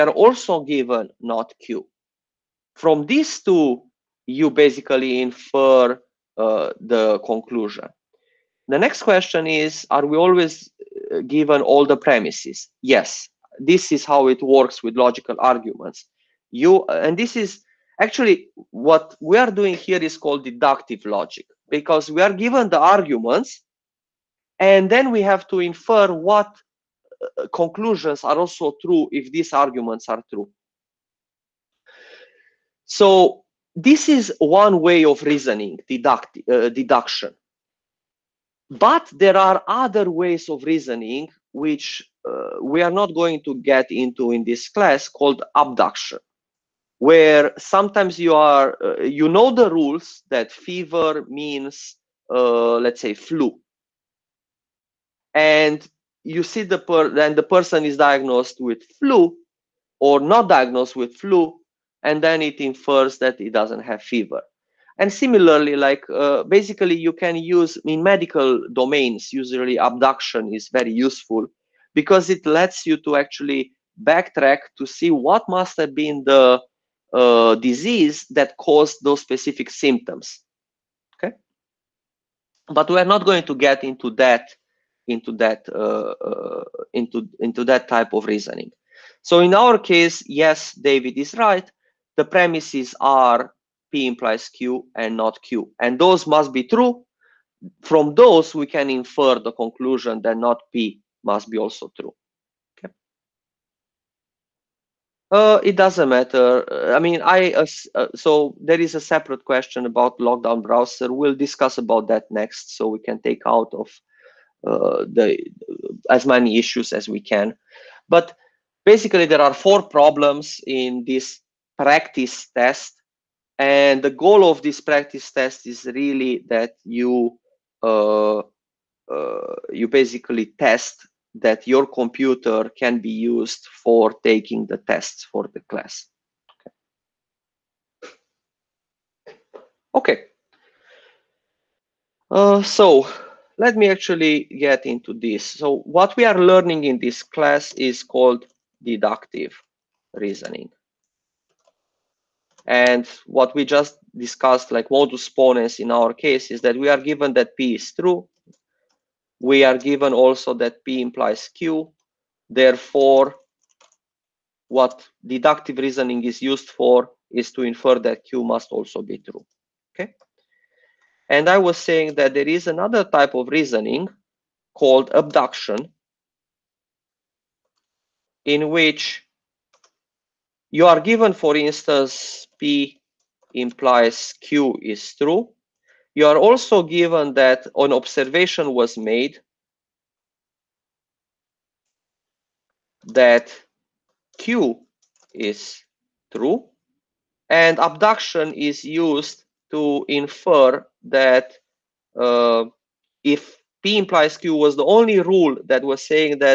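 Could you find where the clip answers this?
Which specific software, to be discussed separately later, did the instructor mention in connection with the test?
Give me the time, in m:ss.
1:50.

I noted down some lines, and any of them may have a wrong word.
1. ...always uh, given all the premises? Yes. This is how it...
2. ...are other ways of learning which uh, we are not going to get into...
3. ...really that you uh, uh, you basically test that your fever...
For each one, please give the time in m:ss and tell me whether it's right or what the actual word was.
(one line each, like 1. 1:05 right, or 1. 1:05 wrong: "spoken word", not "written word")
1. 0:10 right
2. 0:39 wrong: "reasoning", not "learning"
3. 2:05 wrong: "computer", not "fever".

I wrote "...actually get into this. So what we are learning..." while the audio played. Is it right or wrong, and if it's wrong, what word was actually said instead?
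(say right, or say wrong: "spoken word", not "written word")
right.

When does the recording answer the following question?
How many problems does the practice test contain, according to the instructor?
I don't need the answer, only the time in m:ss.
1:59.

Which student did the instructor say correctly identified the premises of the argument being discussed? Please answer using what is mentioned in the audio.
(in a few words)
David.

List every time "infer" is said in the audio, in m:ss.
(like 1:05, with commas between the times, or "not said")
0:05, 0:25, 1:02, 1:38, 2:47, 3:20.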